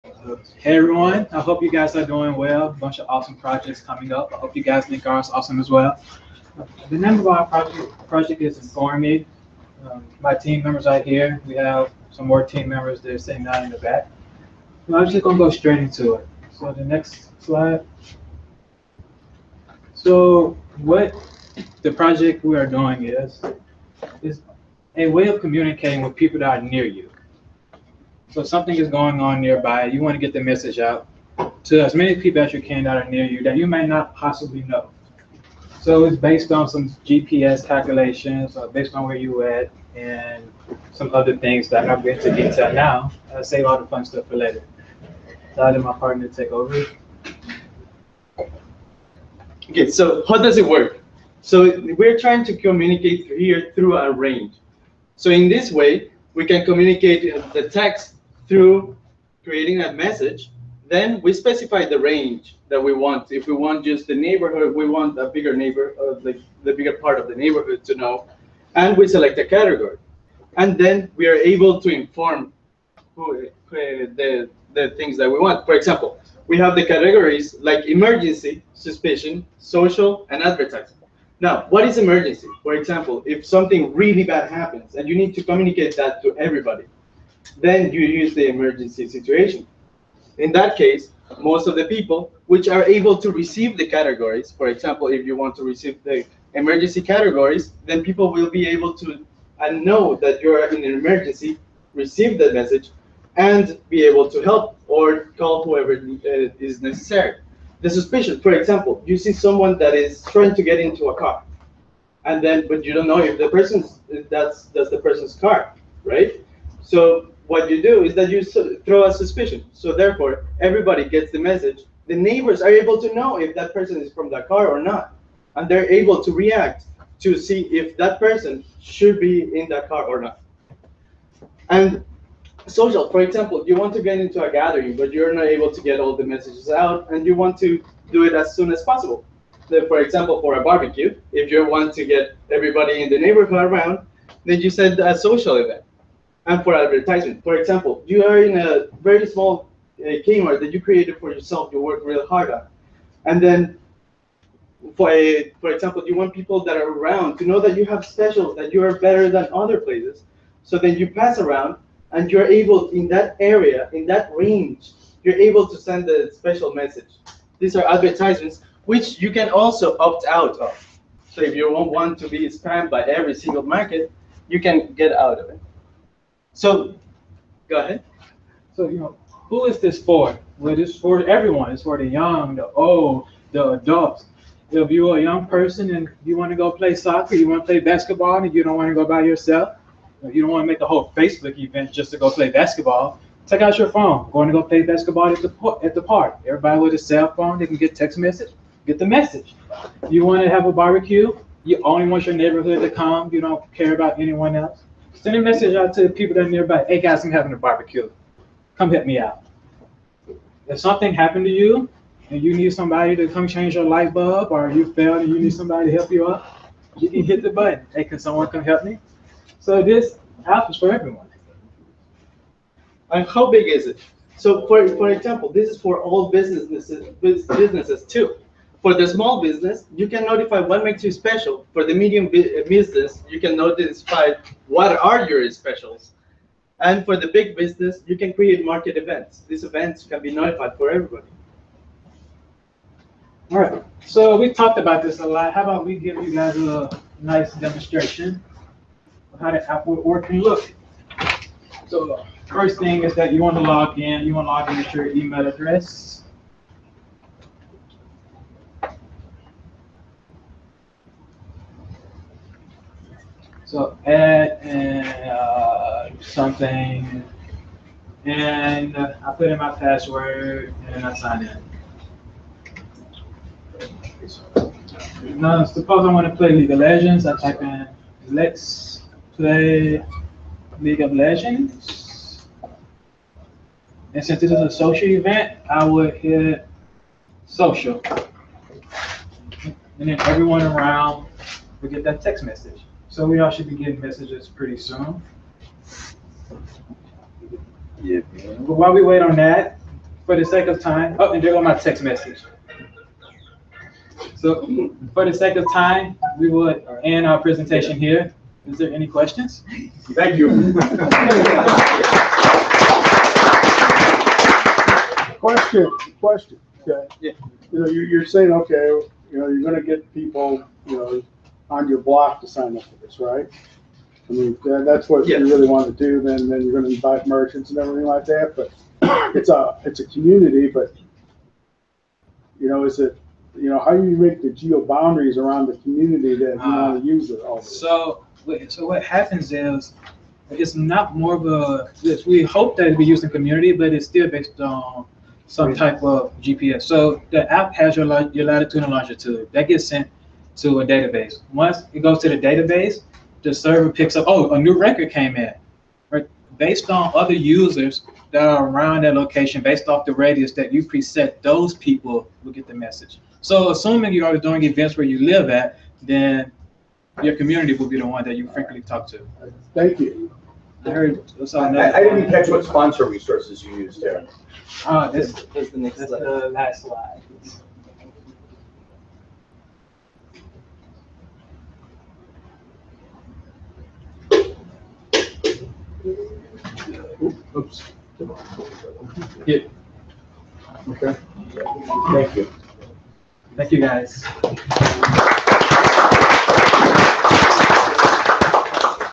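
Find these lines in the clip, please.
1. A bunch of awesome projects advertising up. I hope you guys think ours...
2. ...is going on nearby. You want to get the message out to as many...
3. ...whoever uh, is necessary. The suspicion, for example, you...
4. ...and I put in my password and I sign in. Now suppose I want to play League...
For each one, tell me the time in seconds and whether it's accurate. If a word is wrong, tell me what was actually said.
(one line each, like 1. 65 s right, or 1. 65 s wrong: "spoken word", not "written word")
1. 2 s wrong: "coming", not "advertising"
2. 28 s right
3. 105 s right
4. 268 s right.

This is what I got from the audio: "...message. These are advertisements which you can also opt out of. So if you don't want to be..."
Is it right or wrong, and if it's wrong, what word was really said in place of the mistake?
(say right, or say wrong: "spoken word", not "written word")
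right.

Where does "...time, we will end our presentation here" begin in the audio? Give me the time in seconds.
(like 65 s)
305 s.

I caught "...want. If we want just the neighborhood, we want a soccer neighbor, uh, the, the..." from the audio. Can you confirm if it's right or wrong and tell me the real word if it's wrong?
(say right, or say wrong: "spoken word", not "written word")
wrong: "bigger", not "soccer".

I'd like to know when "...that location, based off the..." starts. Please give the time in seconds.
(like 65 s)
359 s.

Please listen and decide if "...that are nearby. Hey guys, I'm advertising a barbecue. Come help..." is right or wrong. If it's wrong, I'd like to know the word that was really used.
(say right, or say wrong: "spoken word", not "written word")
wrong: "having", not "advertising".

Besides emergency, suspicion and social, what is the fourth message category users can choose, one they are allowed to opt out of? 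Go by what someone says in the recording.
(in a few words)
advertising.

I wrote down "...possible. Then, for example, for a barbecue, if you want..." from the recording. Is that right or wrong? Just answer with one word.
right.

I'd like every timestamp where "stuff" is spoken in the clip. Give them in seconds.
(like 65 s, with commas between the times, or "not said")
44 s.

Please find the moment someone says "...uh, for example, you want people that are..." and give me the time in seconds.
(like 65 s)
155 s.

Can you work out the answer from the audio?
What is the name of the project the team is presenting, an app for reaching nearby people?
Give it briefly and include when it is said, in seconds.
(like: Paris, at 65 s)
Inform Um, at 8 s.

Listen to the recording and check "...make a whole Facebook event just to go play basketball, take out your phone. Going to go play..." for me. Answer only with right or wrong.
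right.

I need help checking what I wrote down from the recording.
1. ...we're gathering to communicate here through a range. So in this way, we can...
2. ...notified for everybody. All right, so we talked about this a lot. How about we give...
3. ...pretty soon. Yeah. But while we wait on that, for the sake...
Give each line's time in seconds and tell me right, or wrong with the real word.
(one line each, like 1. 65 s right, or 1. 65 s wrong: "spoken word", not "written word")
1. 51 s wrong: "trying", not "gathering"
2. 240 s right
3. 294 s right.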